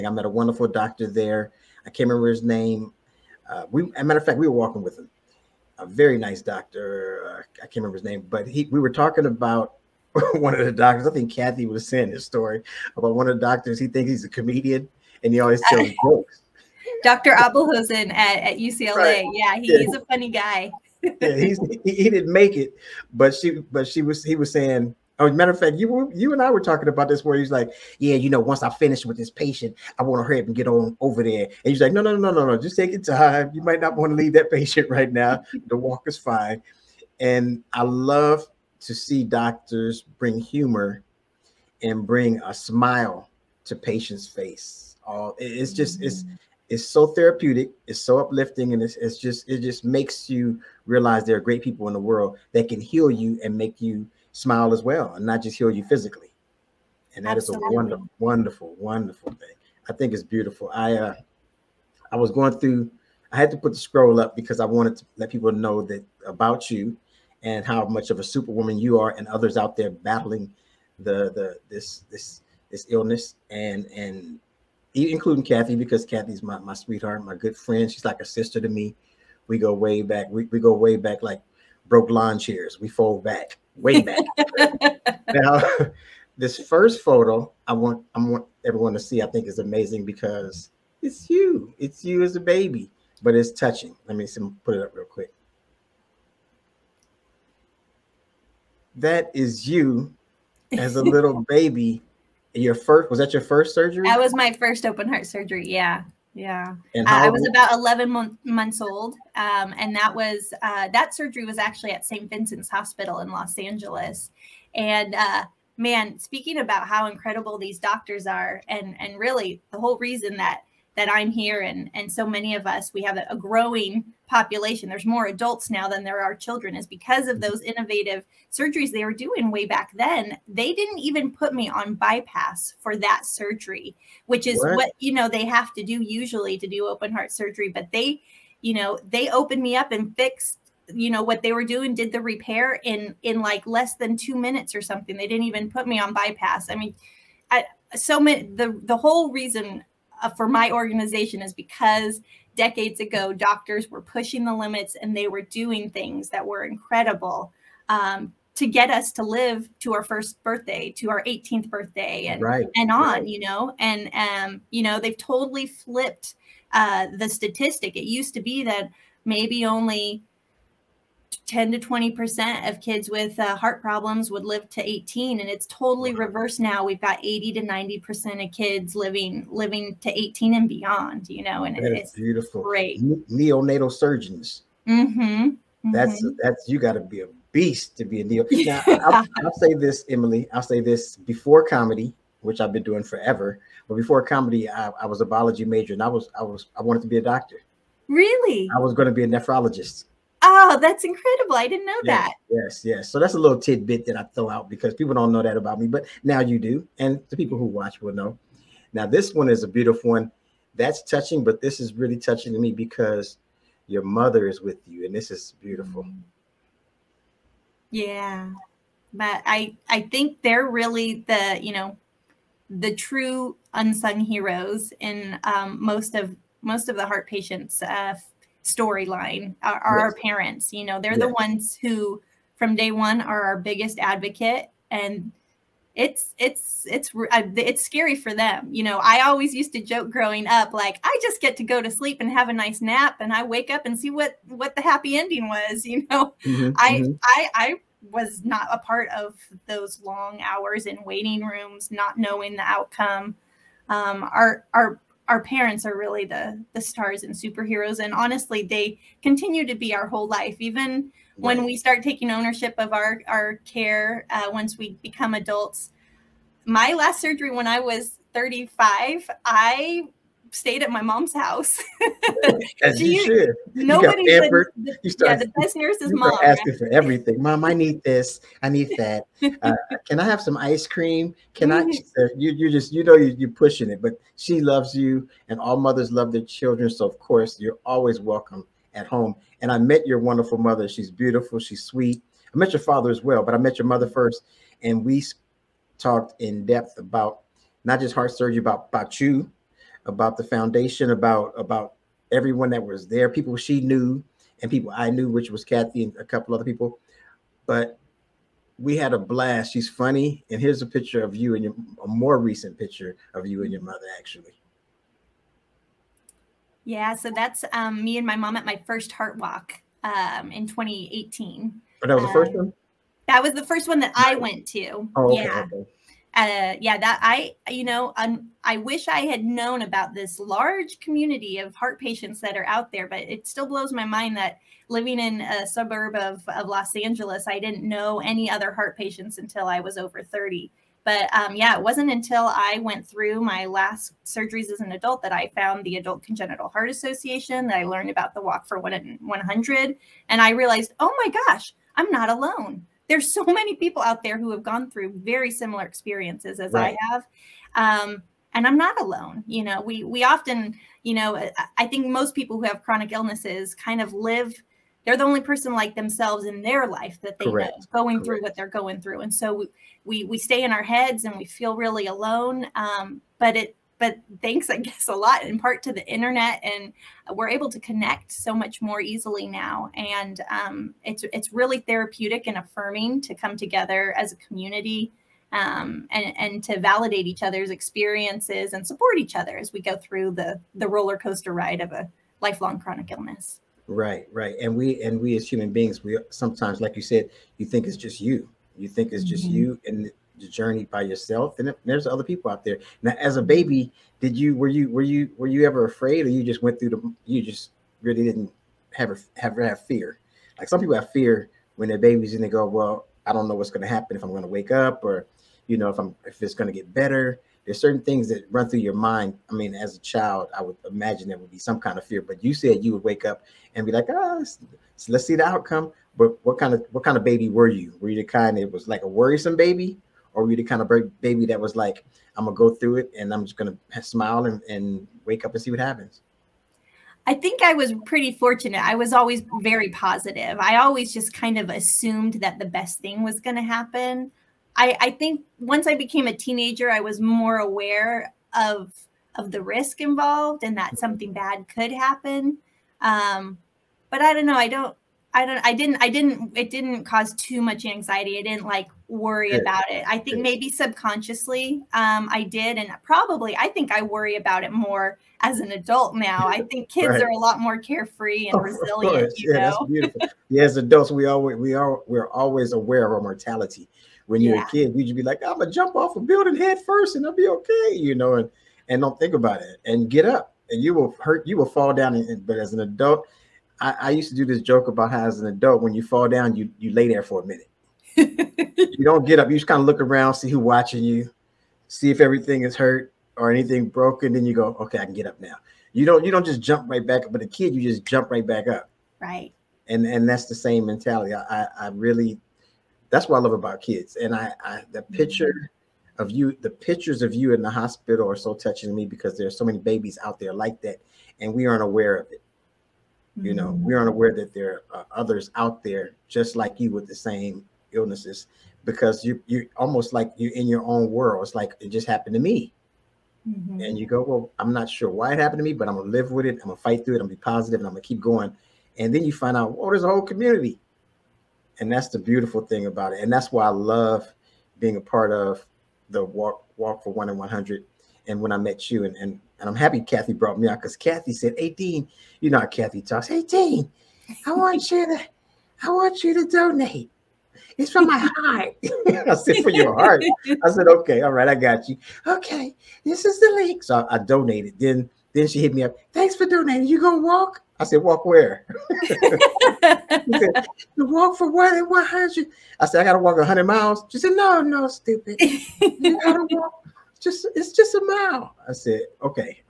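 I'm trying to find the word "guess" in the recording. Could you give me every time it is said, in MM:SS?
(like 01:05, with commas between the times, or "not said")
06:14.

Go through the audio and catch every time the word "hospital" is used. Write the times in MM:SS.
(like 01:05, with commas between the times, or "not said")
01:52, 08:27.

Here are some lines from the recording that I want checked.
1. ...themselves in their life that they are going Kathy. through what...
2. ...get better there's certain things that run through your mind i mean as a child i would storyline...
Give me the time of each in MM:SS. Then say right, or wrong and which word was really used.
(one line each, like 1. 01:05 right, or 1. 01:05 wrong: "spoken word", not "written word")
1. 06:05 wrong: "Correct", not "Kathy"
2. 06:56 wrong: "imagine", not "storyline".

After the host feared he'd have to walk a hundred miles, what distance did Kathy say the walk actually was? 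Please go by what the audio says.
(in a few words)
A mile.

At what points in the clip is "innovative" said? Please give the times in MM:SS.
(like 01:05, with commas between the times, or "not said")
02:07.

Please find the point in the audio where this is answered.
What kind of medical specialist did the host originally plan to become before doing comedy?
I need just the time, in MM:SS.
03:19.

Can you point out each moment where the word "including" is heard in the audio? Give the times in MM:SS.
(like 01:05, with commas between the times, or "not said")
01:14.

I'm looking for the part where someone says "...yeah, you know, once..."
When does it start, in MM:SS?
00:27.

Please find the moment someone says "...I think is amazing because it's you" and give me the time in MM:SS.
01:29.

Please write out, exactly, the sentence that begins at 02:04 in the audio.
There's more adults now than there are children is because of mm-hmm.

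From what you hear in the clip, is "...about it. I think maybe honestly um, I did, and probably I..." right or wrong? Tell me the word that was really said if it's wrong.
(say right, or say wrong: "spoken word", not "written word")
wrong: "subconsciously", not "honestly".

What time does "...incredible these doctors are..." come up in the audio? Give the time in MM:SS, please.
01:57.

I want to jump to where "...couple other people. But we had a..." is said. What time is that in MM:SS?
05:06.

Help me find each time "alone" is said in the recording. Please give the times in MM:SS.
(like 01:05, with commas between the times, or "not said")
05:52, 05:59, 06:12.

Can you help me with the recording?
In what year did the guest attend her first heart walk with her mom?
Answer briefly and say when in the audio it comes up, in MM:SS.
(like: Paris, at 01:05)
2018, at 05:20.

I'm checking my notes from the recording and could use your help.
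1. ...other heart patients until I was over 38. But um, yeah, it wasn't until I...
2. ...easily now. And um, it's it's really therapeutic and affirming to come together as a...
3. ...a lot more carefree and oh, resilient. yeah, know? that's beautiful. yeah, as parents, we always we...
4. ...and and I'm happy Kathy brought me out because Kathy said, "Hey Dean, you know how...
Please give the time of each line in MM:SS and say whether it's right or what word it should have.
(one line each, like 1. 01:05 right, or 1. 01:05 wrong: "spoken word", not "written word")
1. 05:38 wrong: "30", not "38"
2. 06:19 right
3. 07:47 wrong: "adults", not "parents"
4. 08:59 right.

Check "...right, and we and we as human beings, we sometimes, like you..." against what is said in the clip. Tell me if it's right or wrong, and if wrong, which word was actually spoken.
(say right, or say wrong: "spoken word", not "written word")
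right.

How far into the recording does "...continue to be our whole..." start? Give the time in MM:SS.
04:19.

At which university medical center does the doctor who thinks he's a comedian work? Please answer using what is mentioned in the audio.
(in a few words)
UCLA.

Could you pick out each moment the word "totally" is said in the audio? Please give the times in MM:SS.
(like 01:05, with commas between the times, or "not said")
02:45, 02:55.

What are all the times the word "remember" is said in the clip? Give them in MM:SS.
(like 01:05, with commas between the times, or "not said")
00:02, 00:07.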